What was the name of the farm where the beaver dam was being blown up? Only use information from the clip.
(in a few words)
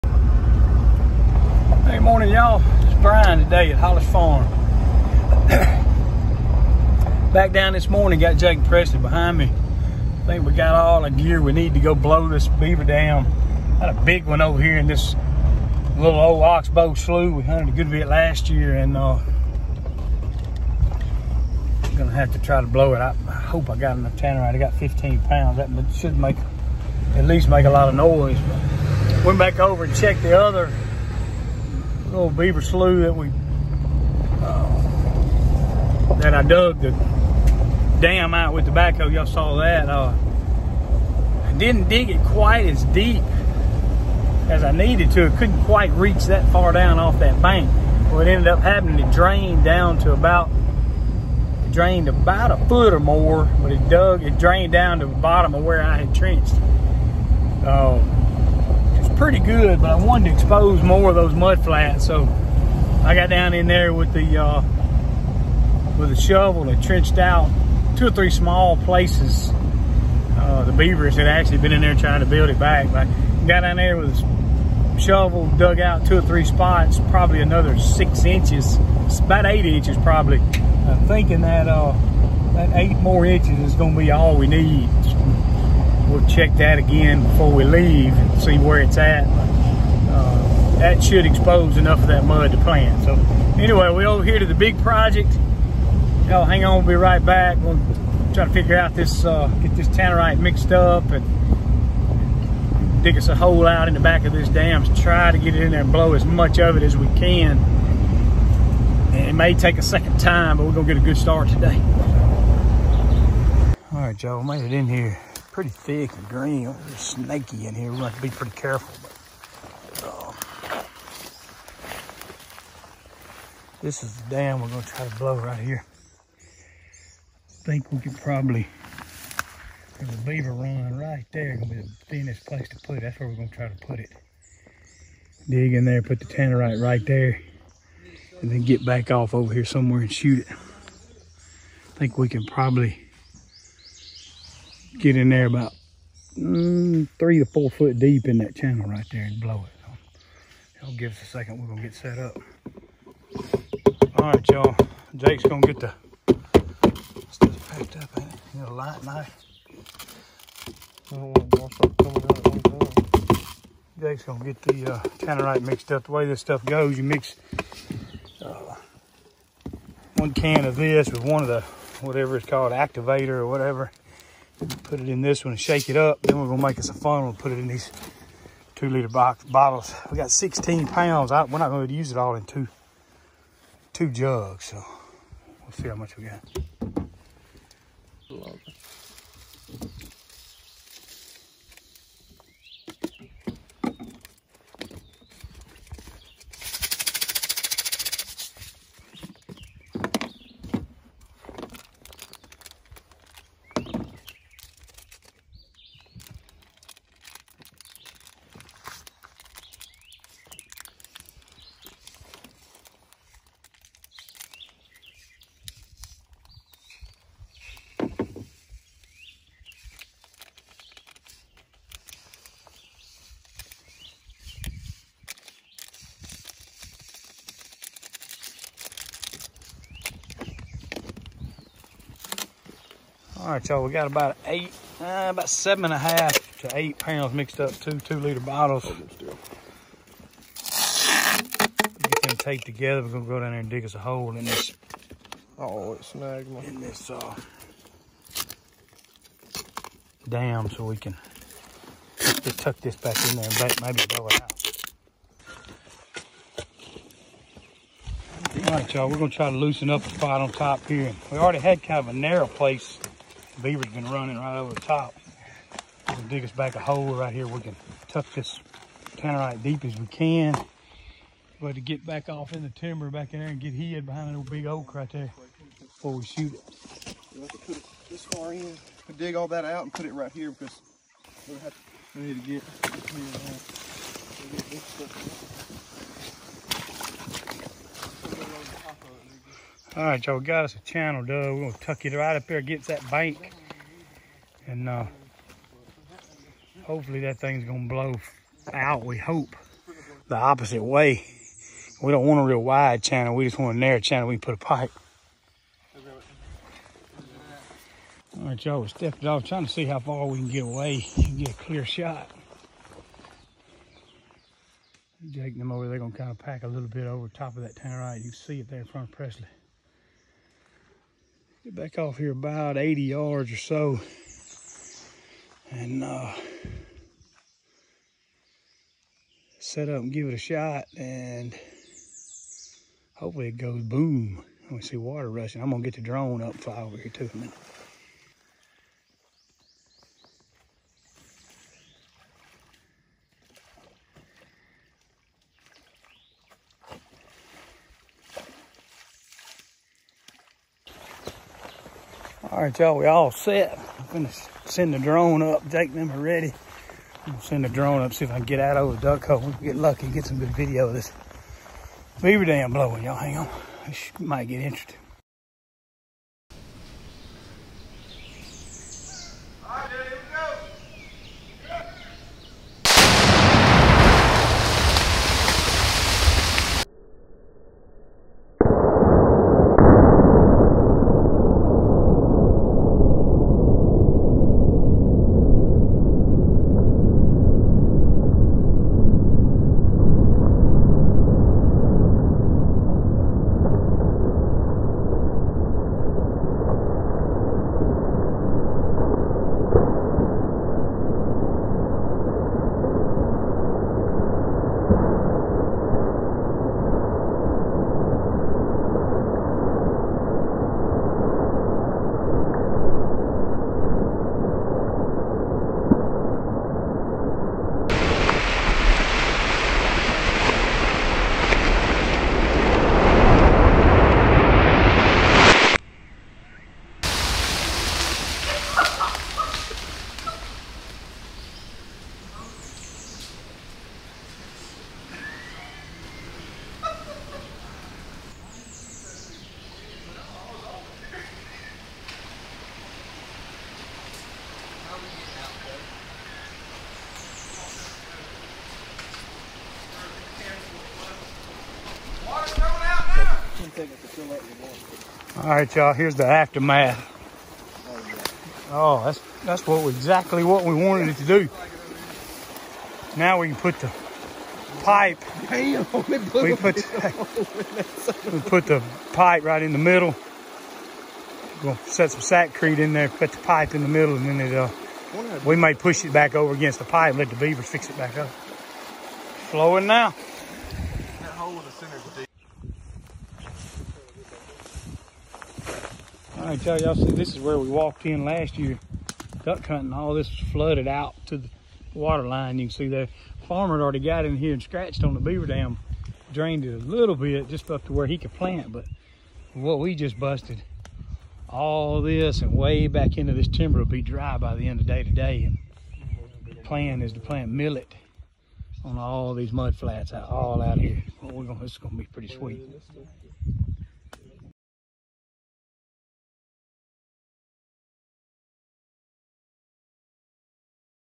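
Hollis Farm.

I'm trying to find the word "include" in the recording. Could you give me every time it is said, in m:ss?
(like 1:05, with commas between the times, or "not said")
not said.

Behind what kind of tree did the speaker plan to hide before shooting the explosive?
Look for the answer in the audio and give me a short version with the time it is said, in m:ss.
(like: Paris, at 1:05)
oak, at 4:34.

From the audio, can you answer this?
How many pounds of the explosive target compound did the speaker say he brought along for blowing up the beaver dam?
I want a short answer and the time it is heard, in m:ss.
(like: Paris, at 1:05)
15, at 0:24.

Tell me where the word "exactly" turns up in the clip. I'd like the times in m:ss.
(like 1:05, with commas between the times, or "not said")
7:39.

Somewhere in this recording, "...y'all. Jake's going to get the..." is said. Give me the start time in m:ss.
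2:34.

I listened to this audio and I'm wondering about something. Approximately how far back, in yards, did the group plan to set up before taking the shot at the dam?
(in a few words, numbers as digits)
80.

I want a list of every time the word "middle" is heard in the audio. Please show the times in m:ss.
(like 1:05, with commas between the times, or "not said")
7:49, 7:53.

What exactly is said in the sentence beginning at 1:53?
All right, Joe, made it in here pretty thick and green.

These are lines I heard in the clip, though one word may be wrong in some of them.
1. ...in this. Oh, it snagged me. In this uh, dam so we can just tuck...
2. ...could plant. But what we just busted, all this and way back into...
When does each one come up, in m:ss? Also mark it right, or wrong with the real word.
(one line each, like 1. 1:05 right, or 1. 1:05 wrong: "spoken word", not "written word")
1. 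4:04 right
2. 8:18 right.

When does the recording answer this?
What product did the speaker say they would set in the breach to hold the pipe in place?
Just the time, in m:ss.
7:52.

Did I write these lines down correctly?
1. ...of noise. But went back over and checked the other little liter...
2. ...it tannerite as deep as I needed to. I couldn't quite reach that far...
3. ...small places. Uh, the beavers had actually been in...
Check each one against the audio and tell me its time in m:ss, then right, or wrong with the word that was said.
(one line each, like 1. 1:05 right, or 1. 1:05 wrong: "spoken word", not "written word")
1. 0:27 wrong: "beaver", not "liter"
2. 0:42 wrong: "quite", not "tannerite"
3. 1:08 right.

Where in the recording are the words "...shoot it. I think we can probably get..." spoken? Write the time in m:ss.
2:20.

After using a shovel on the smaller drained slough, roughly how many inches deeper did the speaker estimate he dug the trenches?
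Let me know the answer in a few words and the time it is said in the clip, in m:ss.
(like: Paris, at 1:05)
8, at 1:19.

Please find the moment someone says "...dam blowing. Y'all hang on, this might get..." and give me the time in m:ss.
6:02.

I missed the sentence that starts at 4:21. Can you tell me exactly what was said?
We already had kind of a narrow place beaver's been running right over the top.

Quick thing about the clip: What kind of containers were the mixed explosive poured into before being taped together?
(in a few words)
two-liter bottles.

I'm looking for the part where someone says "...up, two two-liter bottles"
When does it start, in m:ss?
3:57.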